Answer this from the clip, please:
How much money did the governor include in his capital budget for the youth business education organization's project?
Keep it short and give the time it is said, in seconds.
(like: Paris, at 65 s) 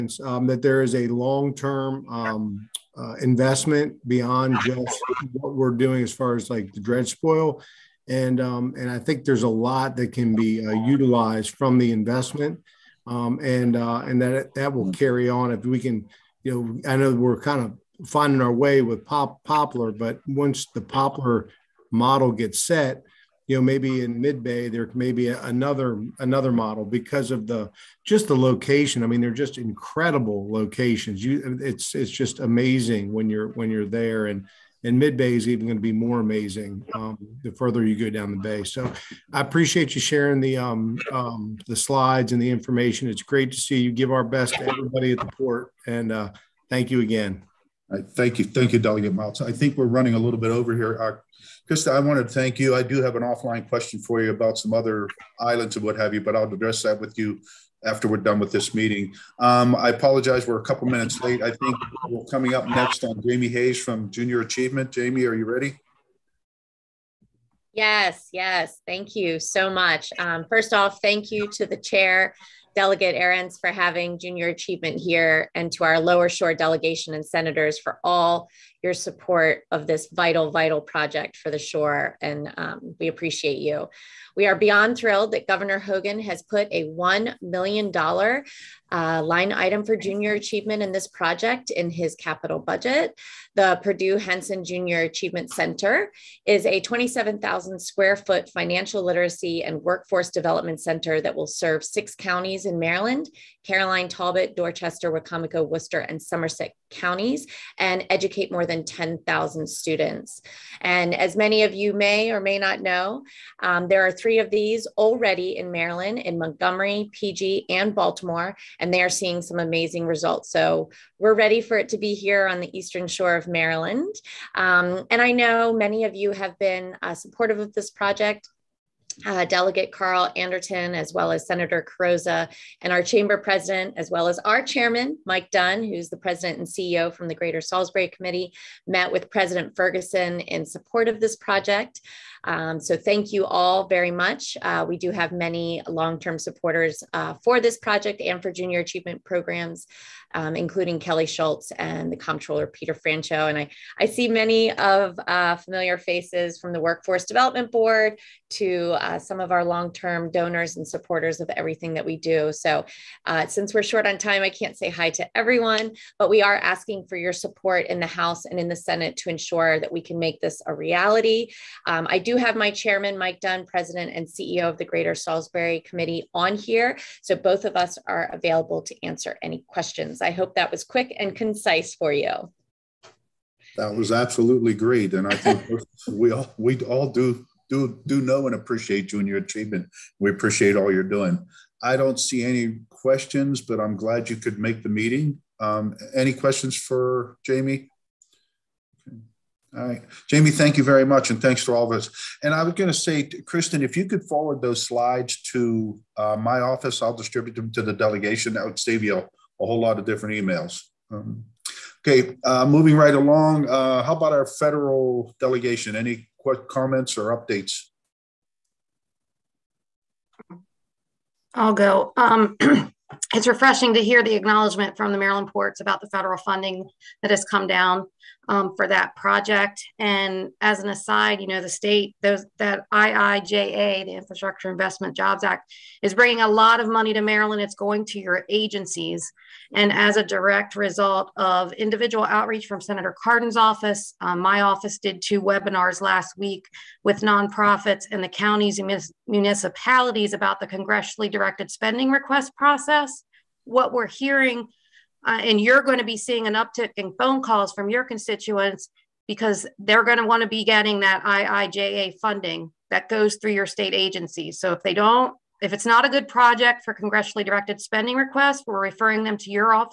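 $1 million, at 86 s.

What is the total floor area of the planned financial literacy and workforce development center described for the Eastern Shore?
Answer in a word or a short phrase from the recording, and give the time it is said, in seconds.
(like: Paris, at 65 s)
27,000 square feet, at 96 s.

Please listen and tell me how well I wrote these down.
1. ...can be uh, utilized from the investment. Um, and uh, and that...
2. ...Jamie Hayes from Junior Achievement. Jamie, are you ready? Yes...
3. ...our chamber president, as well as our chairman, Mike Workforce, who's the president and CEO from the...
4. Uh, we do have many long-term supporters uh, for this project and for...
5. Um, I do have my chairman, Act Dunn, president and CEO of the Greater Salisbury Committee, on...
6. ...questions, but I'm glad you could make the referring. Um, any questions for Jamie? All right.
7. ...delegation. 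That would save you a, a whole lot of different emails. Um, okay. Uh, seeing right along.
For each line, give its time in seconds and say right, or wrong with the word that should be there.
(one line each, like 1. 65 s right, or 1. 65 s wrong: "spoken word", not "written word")
1. 10 s right
2. 63 s right
3. 132 s wrong: "Dunn", not "Workforce"
4. 144 s right
5. 171 s wrong: "Mike", not "Act"
6. 192 s wrong: "meeting", not "referring"
7. 207 s wrong: "moving", not "seeing".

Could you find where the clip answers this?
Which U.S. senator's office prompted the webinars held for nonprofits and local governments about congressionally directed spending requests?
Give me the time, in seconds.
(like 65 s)
242 s.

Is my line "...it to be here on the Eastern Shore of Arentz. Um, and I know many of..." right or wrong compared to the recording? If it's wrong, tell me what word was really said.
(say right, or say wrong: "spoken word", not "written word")
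wrong: "Maryland", not "Arentz".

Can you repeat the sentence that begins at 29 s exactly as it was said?
I mean, they're just incredible locations.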